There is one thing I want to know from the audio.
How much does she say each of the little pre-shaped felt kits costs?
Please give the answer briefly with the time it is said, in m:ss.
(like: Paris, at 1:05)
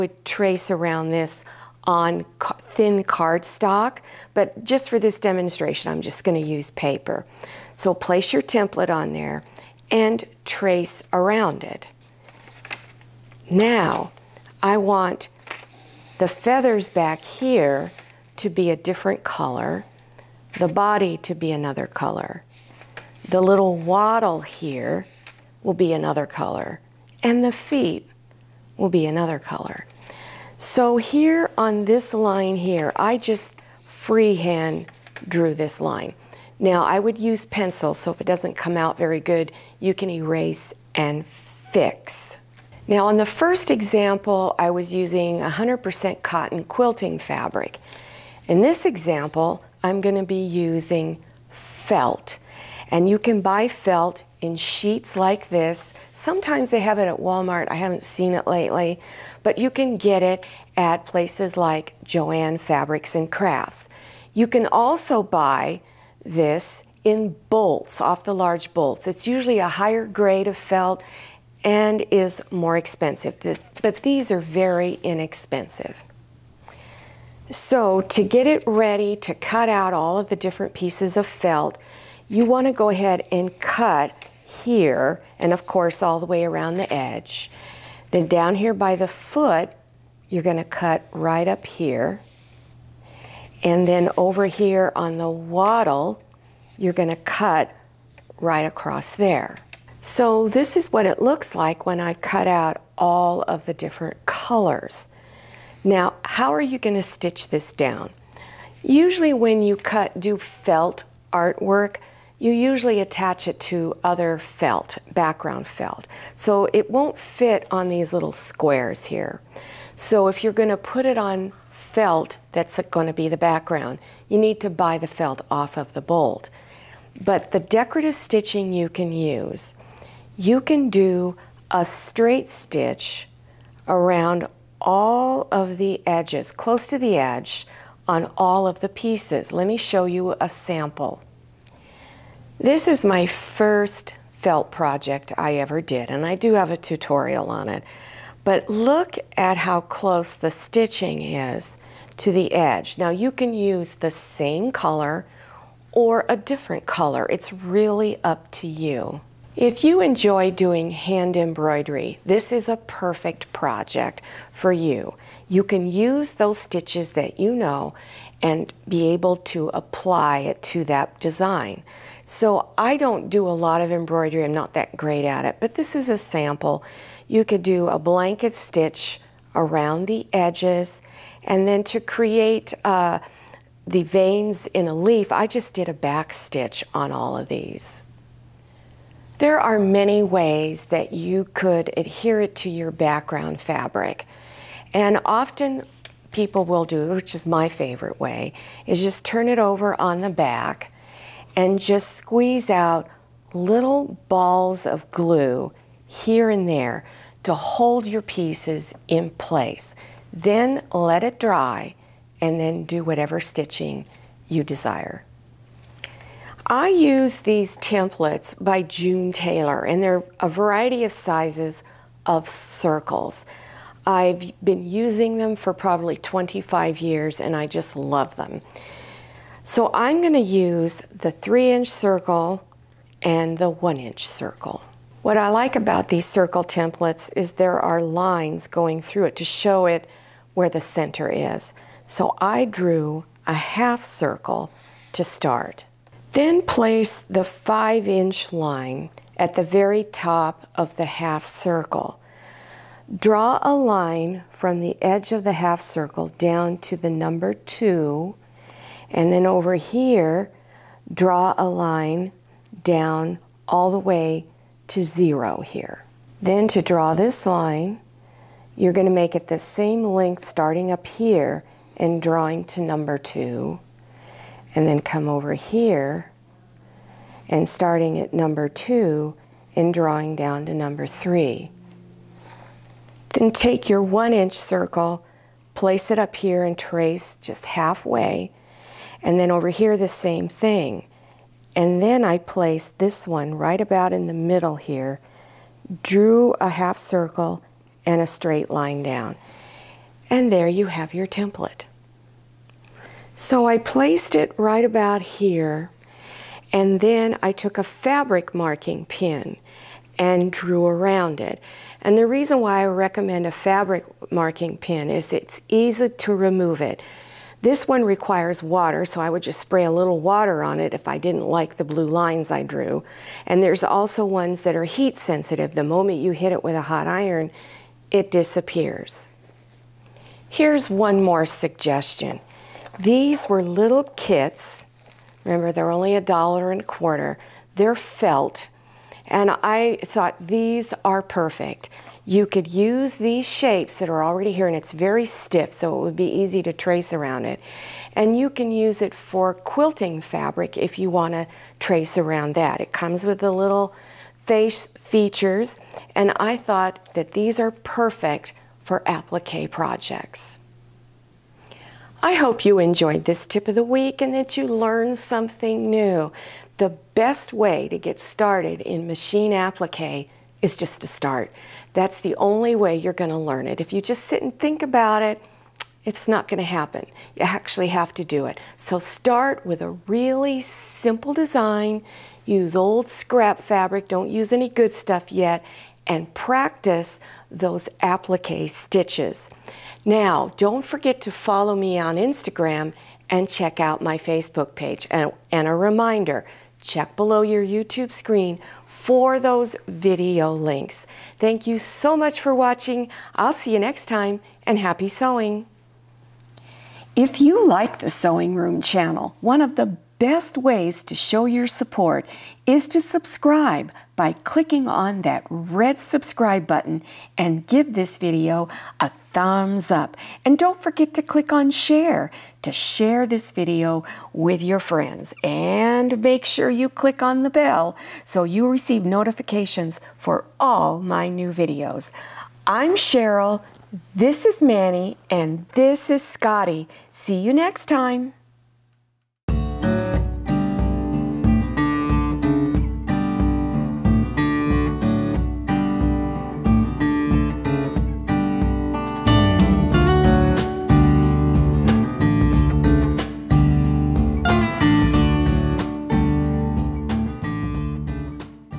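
a dollar and a quarter, at 5:36.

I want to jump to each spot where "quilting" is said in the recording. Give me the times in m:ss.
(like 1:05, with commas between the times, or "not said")
0:46, 5:49.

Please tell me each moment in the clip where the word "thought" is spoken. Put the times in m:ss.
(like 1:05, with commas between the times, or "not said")
5:40, 5:56.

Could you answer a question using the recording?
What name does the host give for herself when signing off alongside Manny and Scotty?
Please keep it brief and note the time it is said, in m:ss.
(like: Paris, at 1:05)
Sherrill, at 7:12.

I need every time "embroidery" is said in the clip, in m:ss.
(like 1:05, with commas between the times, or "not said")
2:41, 2:53.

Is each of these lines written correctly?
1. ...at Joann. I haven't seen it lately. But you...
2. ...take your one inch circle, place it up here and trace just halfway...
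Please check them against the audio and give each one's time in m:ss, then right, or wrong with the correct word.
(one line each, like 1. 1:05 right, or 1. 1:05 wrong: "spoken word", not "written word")
1. 0:57 wrong: "Walmart", not "Joann"
2. 4:43 right.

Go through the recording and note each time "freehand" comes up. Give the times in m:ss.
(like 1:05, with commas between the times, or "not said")
0:33.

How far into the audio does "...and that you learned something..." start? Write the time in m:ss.
6:04.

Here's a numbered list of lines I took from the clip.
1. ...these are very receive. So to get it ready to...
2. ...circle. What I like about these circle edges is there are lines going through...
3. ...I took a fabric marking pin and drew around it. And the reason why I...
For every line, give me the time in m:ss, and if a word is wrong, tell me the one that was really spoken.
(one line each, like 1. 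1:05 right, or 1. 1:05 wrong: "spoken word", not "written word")
1. 1:14 wrong: "inexpensive", not "receive"
2. 3:54 wrong: "templates", not "edges"
3. 5:07 right.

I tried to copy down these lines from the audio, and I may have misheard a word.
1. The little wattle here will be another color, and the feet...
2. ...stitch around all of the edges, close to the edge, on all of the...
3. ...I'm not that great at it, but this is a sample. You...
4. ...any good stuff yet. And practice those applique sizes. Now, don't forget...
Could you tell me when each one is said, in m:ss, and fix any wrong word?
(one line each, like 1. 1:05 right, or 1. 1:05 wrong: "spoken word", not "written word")
1. 0:23 right
2. 2:12 right
3. 2:54 right
4. 6:24 wrong: "stitches", not "sizes".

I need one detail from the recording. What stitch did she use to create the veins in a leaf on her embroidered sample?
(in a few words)
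back stitch.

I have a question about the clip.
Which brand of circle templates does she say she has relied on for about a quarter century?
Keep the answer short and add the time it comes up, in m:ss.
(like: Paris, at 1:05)
June Taylor, at 3:38.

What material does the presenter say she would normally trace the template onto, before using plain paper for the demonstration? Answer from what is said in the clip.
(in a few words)
thin cardstock.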